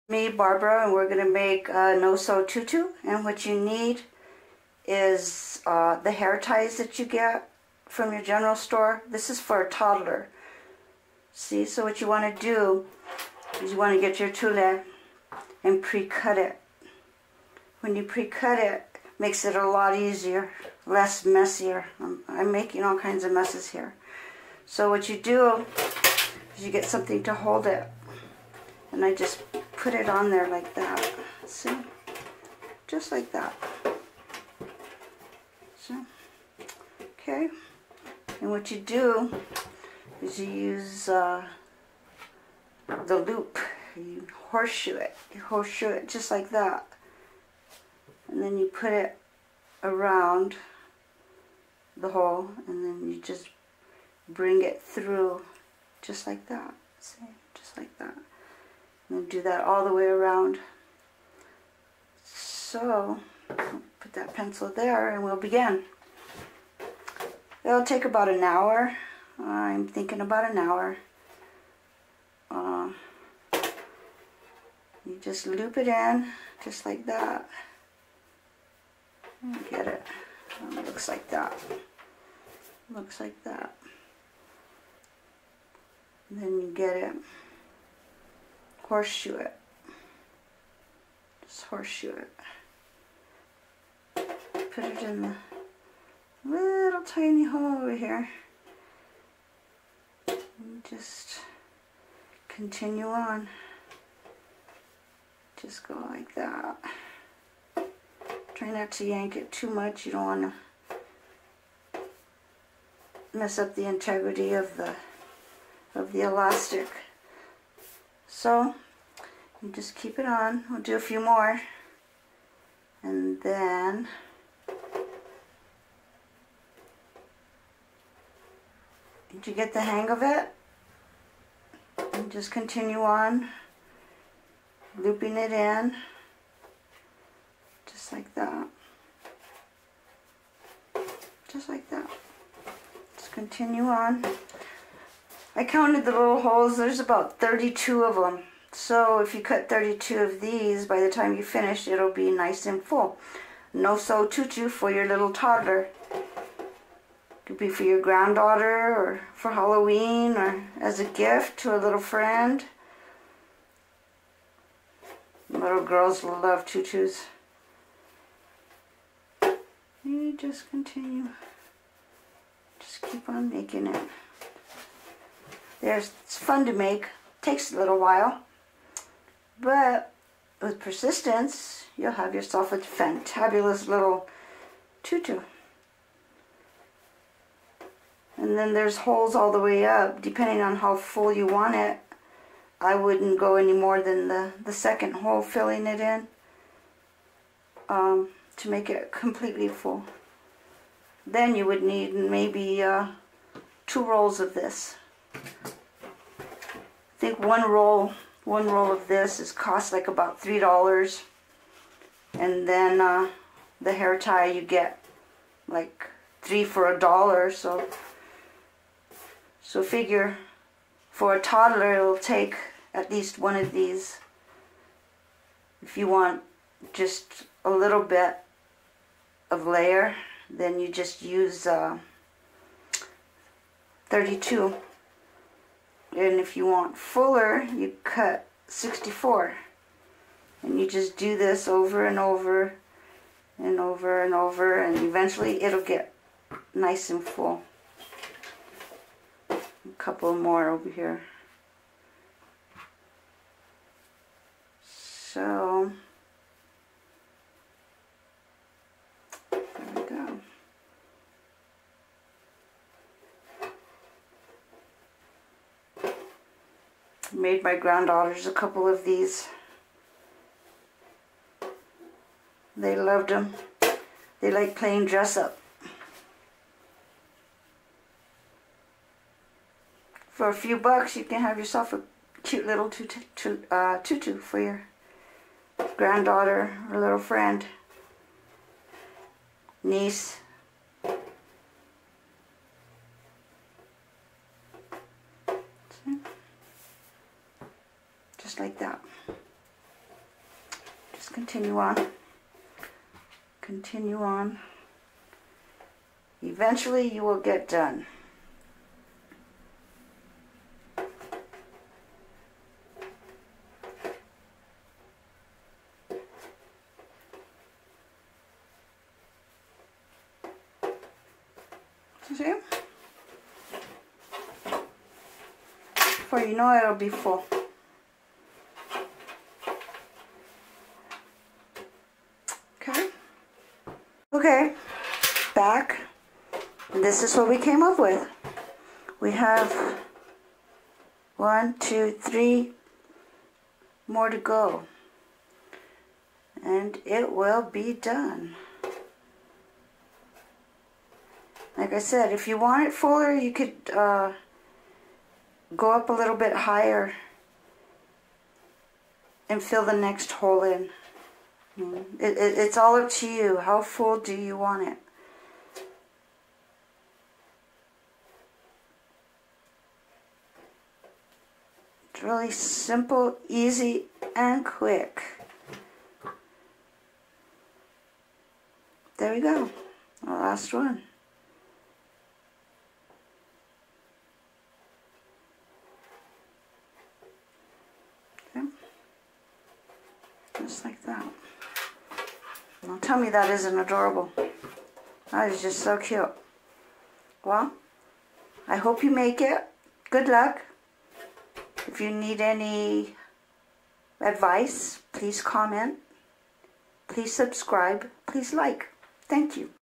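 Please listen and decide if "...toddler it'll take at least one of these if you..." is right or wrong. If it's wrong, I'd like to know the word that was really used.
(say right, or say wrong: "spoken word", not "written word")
right.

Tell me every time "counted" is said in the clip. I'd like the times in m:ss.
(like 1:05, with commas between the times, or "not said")
2:25.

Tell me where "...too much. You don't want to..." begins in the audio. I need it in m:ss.
1:49.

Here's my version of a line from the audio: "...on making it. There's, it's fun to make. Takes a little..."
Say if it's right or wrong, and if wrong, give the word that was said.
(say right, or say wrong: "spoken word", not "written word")
right.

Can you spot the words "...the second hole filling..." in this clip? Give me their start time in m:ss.
3:14.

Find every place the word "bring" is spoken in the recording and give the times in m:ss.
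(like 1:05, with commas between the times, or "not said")
0:54.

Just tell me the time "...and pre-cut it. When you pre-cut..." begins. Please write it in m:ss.
0:15.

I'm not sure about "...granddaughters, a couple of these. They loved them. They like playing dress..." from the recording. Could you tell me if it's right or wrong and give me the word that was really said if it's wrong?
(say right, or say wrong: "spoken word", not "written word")
right.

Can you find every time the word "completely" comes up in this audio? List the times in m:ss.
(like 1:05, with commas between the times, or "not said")
3:19.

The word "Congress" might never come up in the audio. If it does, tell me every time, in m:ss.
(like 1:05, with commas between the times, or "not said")
not said.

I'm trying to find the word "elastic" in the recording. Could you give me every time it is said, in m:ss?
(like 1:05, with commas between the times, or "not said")
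1:56.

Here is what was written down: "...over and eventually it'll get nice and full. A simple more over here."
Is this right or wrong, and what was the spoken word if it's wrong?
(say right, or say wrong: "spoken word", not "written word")
wrong: "couple", not "simple".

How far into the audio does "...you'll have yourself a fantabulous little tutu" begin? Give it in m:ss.
3:01.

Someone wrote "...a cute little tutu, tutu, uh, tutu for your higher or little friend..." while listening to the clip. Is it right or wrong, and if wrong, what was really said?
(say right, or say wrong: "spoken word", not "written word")
wrong: "granddaughter", not "higher".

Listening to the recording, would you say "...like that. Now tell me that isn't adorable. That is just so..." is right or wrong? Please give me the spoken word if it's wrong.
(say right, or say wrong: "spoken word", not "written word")
right.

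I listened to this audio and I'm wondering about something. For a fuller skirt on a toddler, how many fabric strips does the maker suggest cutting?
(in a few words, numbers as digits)
64.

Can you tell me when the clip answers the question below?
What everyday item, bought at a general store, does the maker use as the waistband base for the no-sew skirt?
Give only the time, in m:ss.
0:06.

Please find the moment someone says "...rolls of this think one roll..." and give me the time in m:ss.
3:24.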